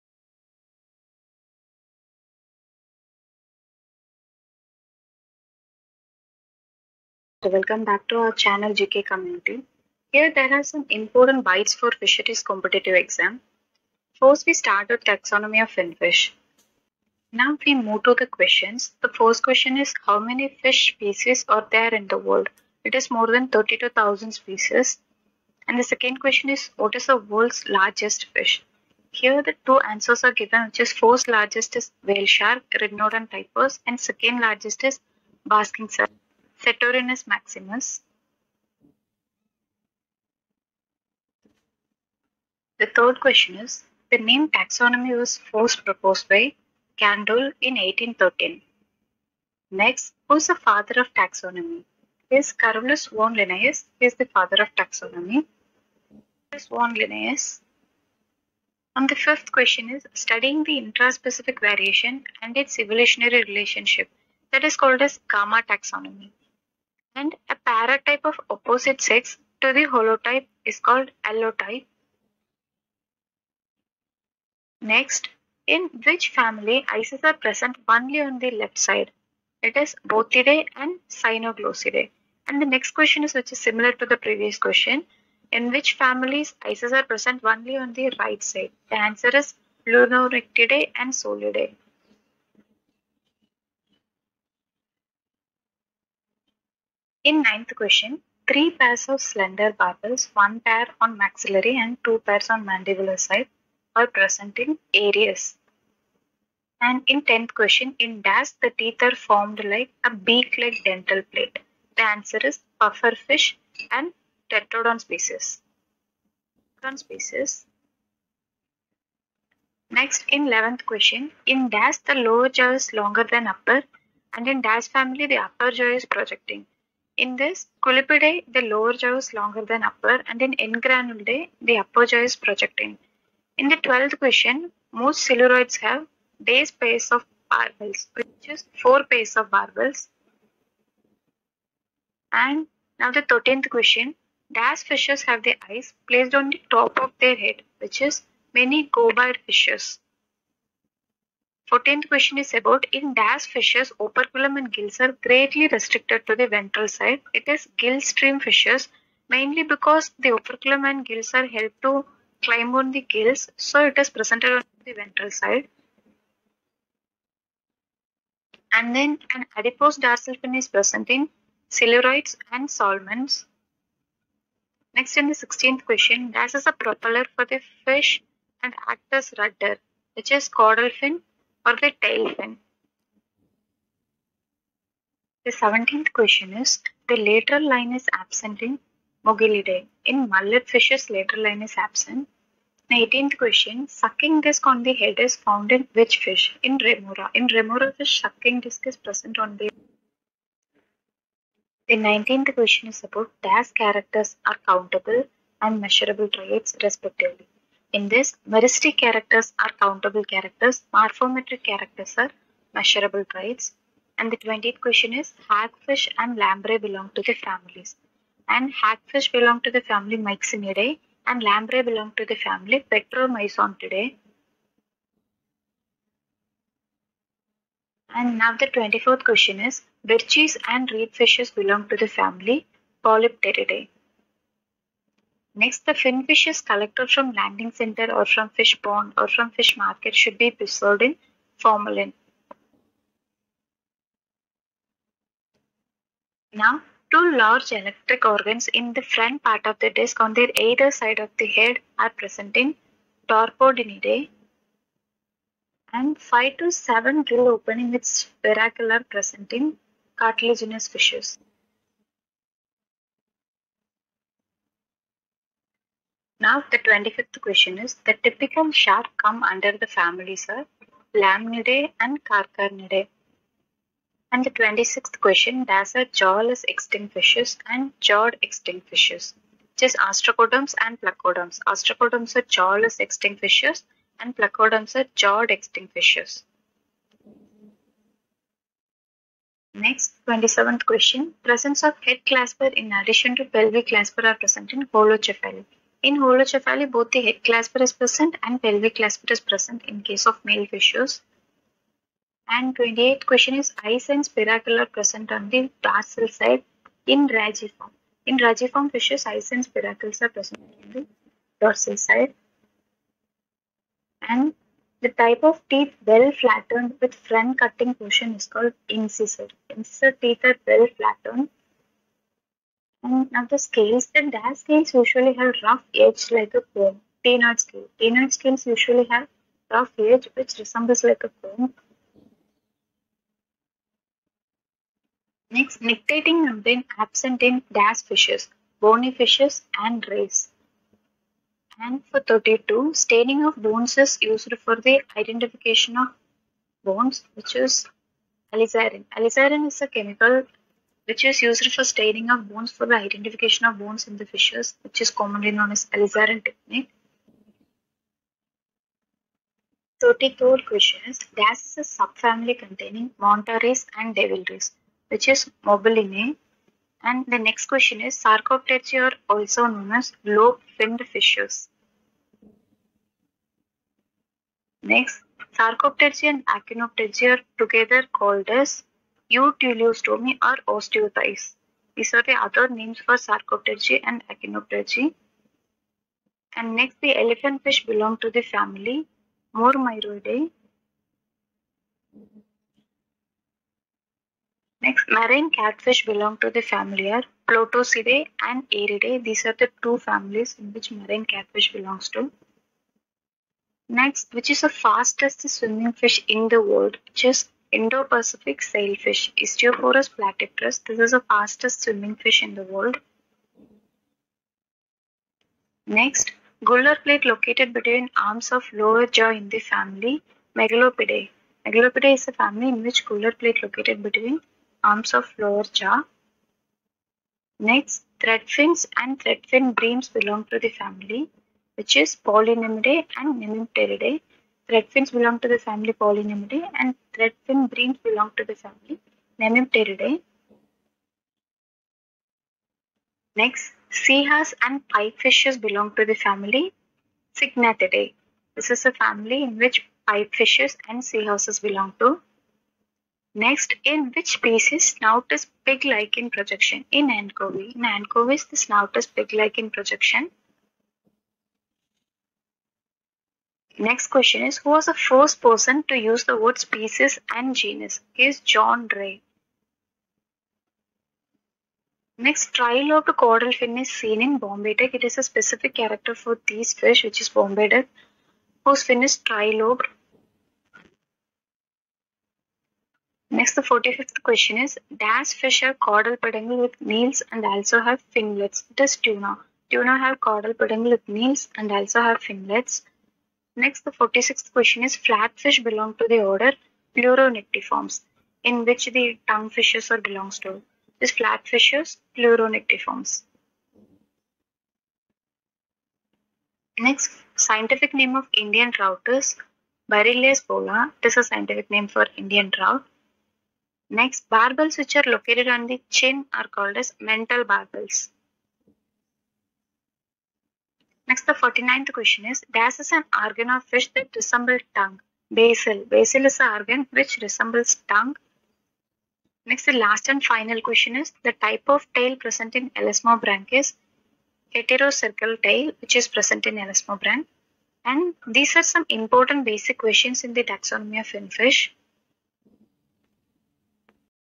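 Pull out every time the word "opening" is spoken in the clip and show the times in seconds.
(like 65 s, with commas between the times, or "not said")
257 s.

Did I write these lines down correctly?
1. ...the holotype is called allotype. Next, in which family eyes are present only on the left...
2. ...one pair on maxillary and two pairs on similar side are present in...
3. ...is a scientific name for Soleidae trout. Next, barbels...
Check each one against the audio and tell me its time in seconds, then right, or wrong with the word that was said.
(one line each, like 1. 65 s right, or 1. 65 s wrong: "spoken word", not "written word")
1. 69 s right
2. 100 s wrong: "mandibular", not "similar"
3. 511 s wrong: "Indian", not "Soleidae".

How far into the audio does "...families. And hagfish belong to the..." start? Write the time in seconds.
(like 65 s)
217 s.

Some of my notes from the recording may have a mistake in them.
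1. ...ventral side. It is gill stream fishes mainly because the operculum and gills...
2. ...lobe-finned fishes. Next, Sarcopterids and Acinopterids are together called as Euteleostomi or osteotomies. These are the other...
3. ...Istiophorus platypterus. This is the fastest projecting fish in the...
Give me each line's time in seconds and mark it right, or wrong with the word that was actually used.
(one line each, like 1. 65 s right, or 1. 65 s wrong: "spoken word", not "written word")
1. 156 s right
2. 370 s right
3. 409 s wrong: "swimming", not "projecting".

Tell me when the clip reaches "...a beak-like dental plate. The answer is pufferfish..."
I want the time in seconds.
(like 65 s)
110 s.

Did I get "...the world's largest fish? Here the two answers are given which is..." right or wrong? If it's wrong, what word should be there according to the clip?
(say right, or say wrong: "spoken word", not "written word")
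right.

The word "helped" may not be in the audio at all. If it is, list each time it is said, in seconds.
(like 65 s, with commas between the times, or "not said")
161 s.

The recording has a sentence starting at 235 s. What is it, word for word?
Next, the finfishes is collected from landing center or from fish pond or from fish market should be preserved in formalin.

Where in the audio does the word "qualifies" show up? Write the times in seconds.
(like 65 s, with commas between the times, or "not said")
not said.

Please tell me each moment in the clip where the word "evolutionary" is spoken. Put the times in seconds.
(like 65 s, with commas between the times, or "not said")
62 s.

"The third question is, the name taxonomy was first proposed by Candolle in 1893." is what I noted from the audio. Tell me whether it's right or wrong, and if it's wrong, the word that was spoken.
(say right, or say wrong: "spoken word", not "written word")
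wrong: "1813", not "1893".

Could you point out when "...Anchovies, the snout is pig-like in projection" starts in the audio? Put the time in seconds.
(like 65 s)
457 s.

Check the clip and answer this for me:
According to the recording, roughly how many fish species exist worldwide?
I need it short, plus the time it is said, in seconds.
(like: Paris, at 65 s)
More than 32,000, at 23 s.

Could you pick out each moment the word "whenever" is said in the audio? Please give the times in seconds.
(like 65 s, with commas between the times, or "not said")
not said.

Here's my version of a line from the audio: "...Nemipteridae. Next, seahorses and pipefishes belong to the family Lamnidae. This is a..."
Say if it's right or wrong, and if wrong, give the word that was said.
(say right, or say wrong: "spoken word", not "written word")
wrong: "Syngnathidae", not "Lamnidae".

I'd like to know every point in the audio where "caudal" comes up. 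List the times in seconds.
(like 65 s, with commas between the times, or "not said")
180 s, 473 s, 485 s, 490 s.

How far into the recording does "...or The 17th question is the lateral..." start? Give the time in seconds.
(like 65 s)
181 s.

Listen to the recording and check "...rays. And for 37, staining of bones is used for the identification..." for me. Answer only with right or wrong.
wrong.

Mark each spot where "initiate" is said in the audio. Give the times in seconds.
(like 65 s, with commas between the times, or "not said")
not said.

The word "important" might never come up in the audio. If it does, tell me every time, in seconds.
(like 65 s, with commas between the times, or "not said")
10 s, 538 s.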